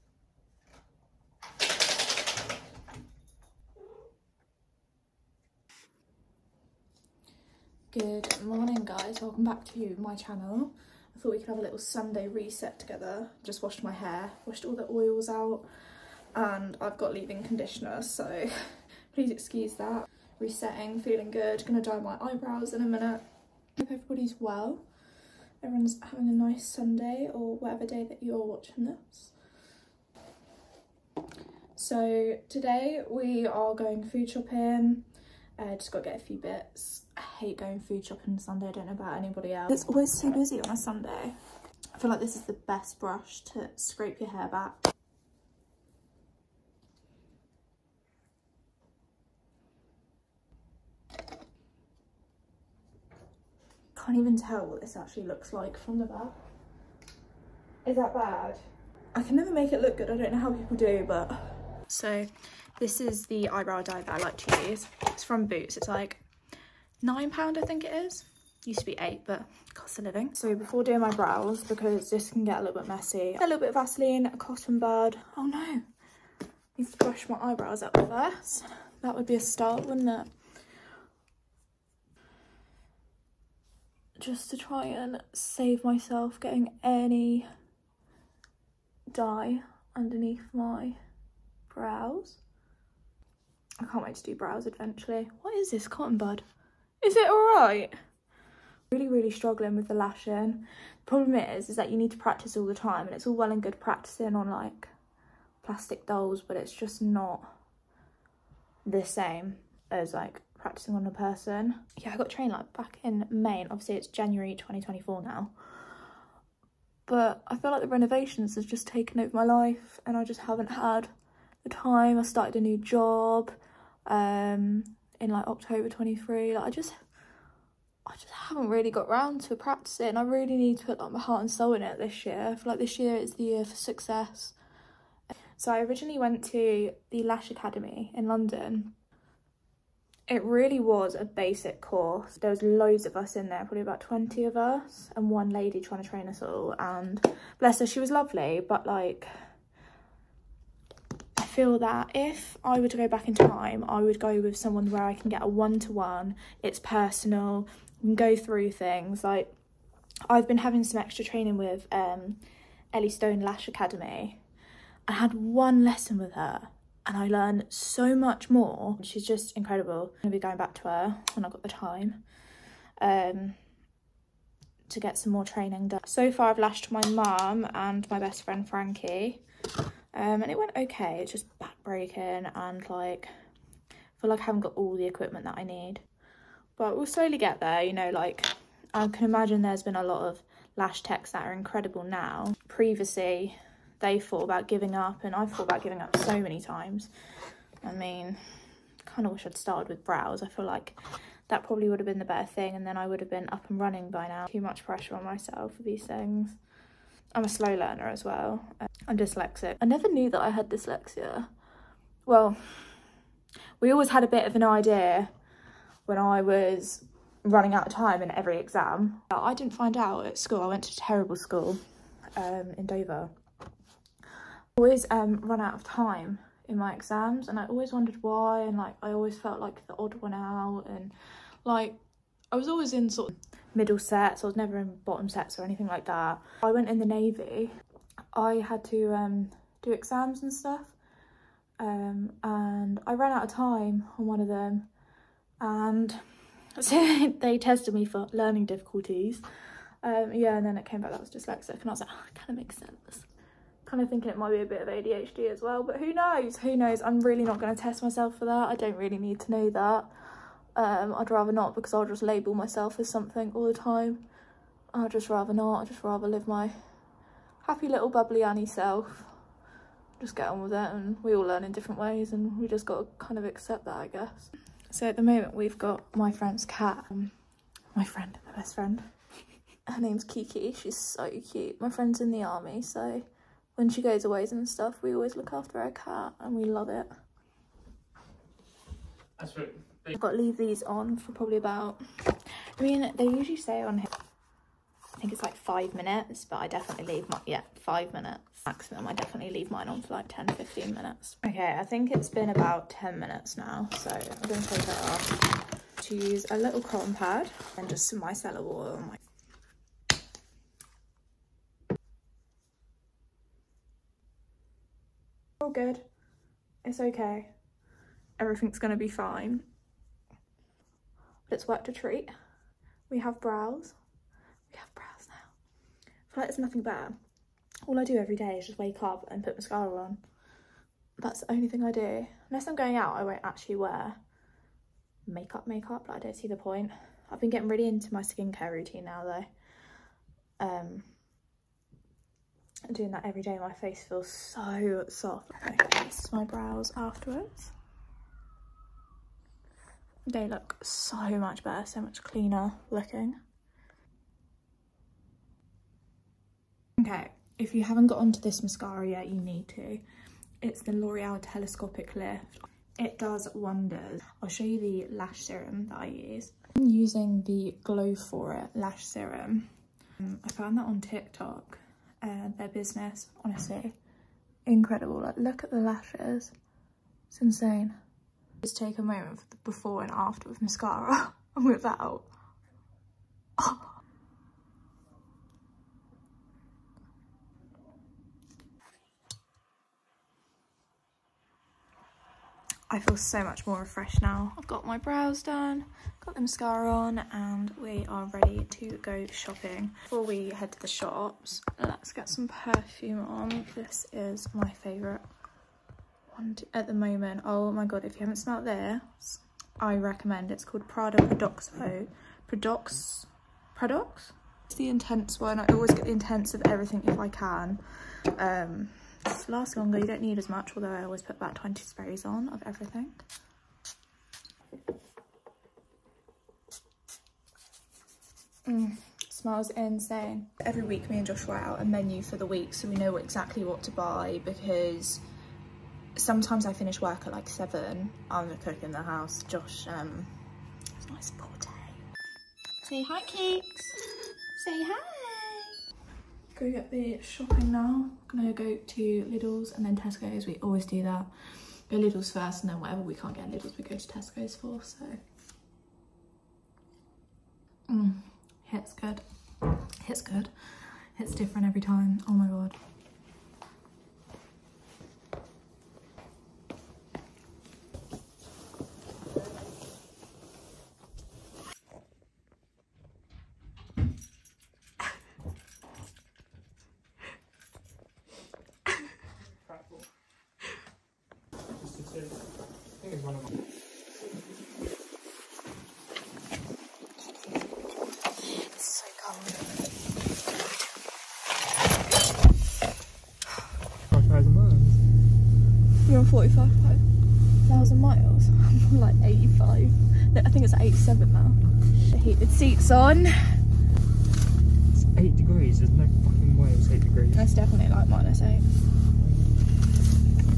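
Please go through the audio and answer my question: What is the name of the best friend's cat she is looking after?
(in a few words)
Kiki.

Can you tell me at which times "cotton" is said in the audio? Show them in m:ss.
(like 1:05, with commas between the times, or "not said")
1:14, 1:35, 5:06.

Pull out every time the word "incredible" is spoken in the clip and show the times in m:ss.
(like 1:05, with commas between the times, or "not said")
2:49, 3:11, 6:14.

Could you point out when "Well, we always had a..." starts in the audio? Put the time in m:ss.
3:32.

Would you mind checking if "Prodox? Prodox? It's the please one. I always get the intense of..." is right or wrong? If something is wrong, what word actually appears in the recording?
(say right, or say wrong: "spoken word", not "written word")
wrong: "intense", not "please".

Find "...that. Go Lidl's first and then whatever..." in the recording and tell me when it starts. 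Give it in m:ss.
7:31.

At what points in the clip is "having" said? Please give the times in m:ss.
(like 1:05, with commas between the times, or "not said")
0:26, 2:40.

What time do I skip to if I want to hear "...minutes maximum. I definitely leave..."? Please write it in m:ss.
4:58.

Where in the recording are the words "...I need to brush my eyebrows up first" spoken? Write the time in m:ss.
1:15.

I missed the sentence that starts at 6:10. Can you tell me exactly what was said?
Um, I found that on TikTok, uh, their business, honestly.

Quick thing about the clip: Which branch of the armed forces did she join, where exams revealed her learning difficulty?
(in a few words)
the Navy.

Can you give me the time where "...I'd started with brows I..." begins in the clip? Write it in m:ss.
3:19.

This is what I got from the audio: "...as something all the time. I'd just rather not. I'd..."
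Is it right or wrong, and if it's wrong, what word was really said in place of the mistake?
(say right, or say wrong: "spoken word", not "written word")
right.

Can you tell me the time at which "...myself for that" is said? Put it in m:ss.
4:18.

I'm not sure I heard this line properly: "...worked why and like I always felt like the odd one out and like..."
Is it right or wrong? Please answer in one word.
wrong.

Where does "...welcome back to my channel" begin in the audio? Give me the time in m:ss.
0:09.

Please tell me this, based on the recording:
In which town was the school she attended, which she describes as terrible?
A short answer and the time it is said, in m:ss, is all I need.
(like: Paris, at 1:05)
Dover, at 3:42.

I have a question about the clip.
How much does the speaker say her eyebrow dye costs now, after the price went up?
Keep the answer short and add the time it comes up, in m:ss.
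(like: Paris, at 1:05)
£9, at 1:07.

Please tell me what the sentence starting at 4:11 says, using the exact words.
And I was like, oh, it kind of makes sense.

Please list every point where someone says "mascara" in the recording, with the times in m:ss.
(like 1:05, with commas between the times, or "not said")
5:29, 5:58, 6:20, 6:36.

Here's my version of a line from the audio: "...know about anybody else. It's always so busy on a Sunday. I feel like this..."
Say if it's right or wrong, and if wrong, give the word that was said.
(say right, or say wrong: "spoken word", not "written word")
right.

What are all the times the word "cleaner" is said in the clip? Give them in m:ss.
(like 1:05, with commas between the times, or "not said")
5:52.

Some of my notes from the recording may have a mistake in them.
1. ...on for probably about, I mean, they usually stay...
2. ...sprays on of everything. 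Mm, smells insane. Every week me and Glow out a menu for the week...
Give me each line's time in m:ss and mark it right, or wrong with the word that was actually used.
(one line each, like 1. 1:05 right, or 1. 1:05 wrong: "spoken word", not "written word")
1. 4:50 right
2. 7:01 wrong: "Joshua", not "Glow".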